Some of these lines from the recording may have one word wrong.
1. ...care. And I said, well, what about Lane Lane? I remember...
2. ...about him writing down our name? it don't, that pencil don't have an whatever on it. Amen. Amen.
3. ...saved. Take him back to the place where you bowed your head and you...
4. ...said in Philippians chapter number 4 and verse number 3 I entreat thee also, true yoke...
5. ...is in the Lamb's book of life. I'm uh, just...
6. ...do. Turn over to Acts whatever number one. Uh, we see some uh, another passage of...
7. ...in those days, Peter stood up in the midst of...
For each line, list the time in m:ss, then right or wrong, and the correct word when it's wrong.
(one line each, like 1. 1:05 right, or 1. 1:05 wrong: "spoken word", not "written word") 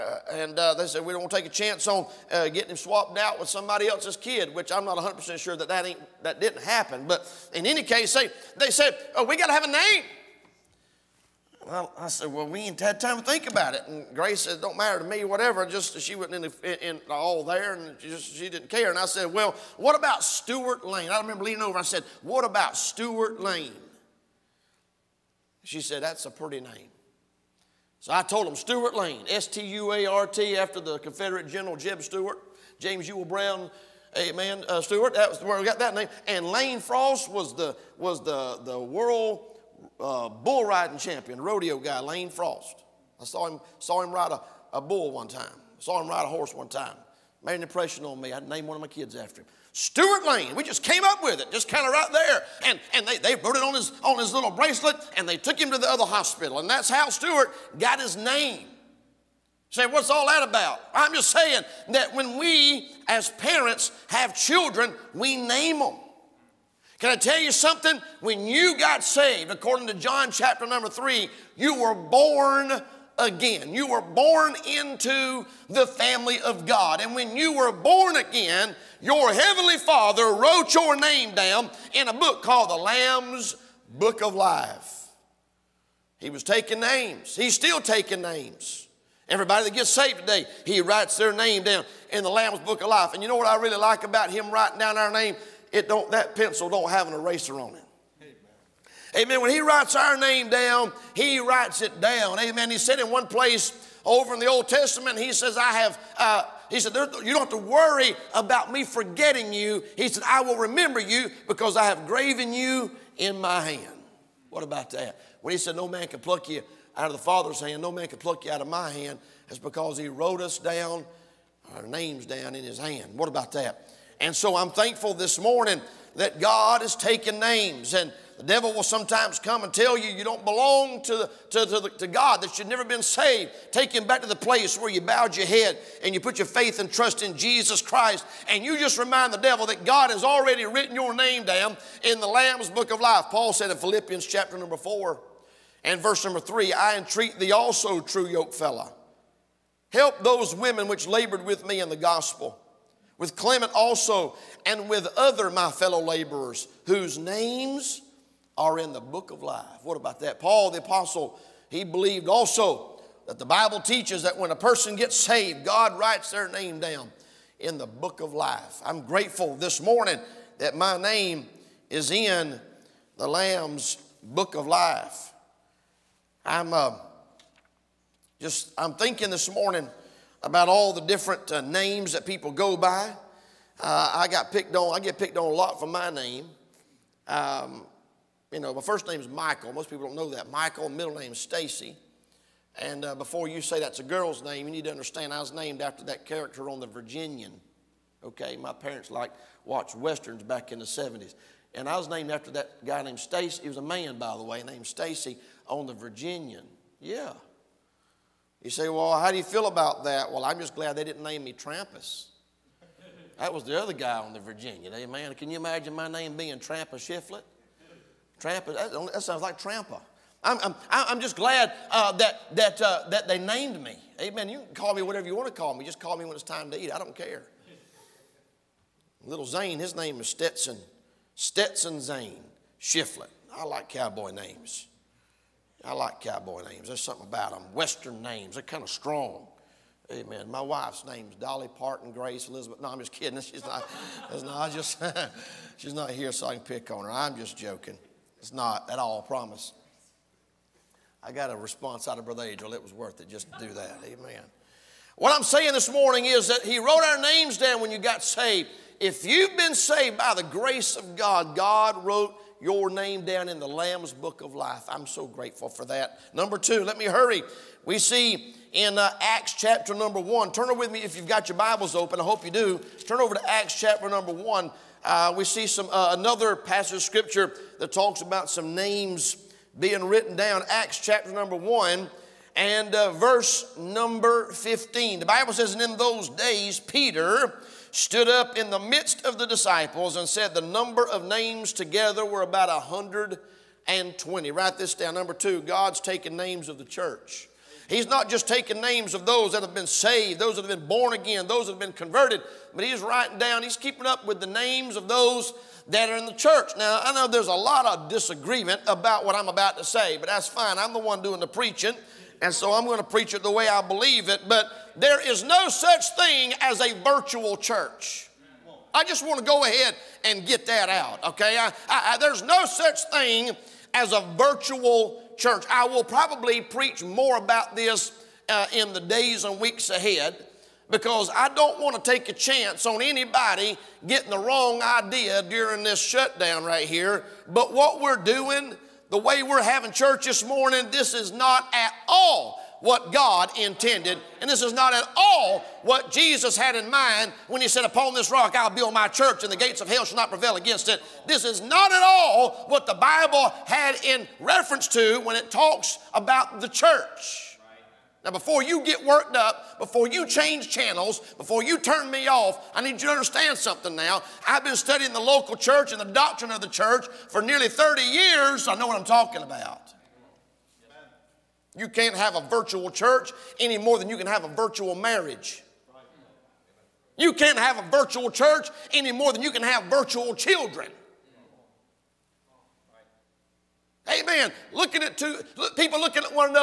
1. 0:18 wrong: "Stuart", not "Lane"
2. 1:34 wrong: "eraser", not "whatever"
3. 2:13 right
4. 2:23 right
5. 2:51 right
6. 4:32 wrong: "chapter", not "whatever"
7. 4:45 right.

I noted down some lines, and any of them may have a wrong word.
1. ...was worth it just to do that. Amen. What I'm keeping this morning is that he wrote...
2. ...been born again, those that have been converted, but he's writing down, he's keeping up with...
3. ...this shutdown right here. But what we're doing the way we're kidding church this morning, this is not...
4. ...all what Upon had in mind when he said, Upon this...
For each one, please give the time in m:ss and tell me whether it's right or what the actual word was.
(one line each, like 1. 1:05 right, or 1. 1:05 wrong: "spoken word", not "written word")
1. 4:12 wrong: "saying", not "keeping"
2. 5:00 right
3. 5:35 wrong: "having", not "kidding"
4. 5:45 wrong: "Jesus", not "Upon".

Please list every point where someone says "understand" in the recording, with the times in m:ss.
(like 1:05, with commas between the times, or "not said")
3:14, 6:03.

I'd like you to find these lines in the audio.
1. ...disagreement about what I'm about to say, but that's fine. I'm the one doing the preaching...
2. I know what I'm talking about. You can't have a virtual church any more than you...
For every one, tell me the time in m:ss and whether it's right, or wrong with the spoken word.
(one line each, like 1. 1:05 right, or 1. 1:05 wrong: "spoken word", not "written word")
1. 5:08 right
2. 6:08 right.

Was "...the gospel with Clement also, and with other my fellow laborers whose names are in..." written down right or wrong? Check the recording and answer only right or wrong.
right.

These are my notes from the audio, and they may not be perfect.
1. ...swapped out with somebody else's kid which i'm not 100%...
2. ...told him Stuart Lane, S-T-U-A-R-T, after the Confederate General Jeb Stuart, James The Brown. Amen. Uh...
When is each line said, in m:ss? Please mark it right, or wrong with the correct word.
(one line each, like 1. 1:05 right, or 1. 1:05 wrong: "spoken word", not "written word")
1. 0:02 right
2. 0:28 wrong: "Ewell", not "The".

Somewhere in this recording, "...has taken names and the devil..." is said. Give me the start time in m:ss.
2:06.